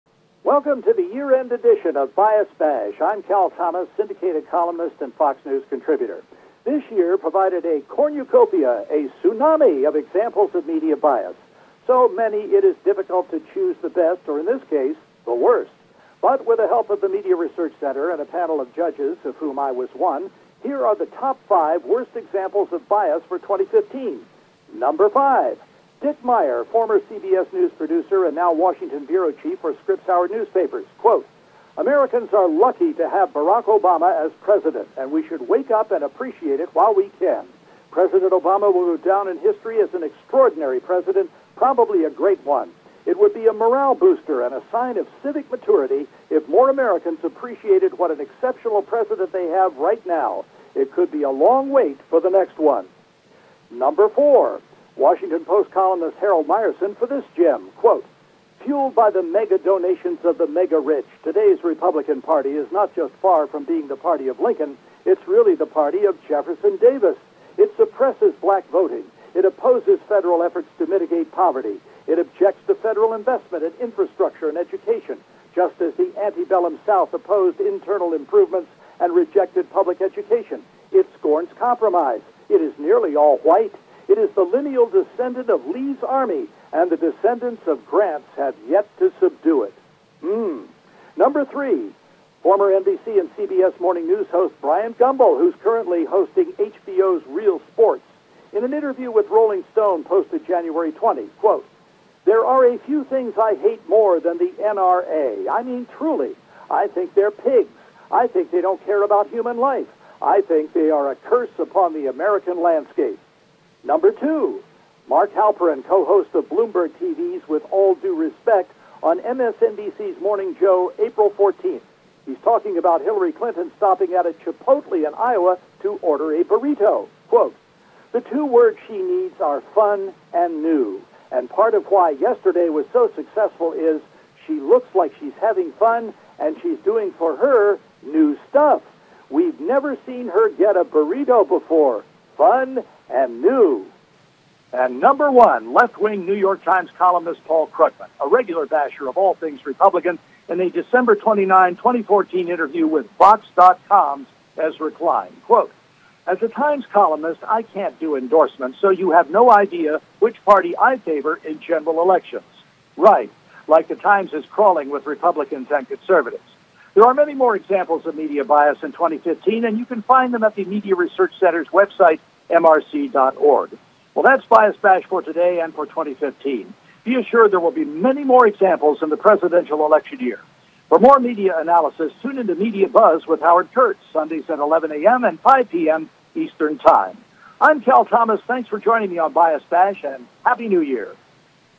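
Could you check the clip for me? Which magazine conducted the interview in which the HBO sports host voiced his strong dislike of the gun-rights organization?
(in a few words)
Rolling Stone.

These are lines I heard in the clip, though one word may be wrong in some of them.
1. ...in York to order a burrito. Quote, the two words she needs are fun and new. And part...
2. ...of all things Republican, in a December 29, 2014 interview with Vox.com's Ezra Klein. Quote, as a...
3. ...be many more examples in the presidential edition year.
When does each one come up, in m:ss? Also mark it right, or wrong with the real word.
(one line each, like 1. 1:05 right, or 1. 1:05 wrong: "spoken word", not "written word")
1. 2:05 wrong: "Iowa", not "York"
2. 2:29 right
3. 2:57 wrong: "election", not "edition".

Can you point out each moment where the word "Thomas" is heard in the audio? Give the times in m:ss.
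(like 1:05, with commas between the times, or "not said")
0:03, 3:08.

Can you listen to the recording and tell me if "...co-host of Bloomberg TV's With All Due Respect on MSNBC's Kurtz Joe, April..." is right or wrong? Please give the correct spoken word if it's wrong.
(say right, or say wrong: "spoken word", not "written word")
wrong: "Morning", not "Kurtz".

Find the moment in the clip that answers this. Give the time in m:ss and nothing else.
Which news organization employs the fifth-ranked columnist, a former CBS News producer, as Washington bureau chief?
0:29.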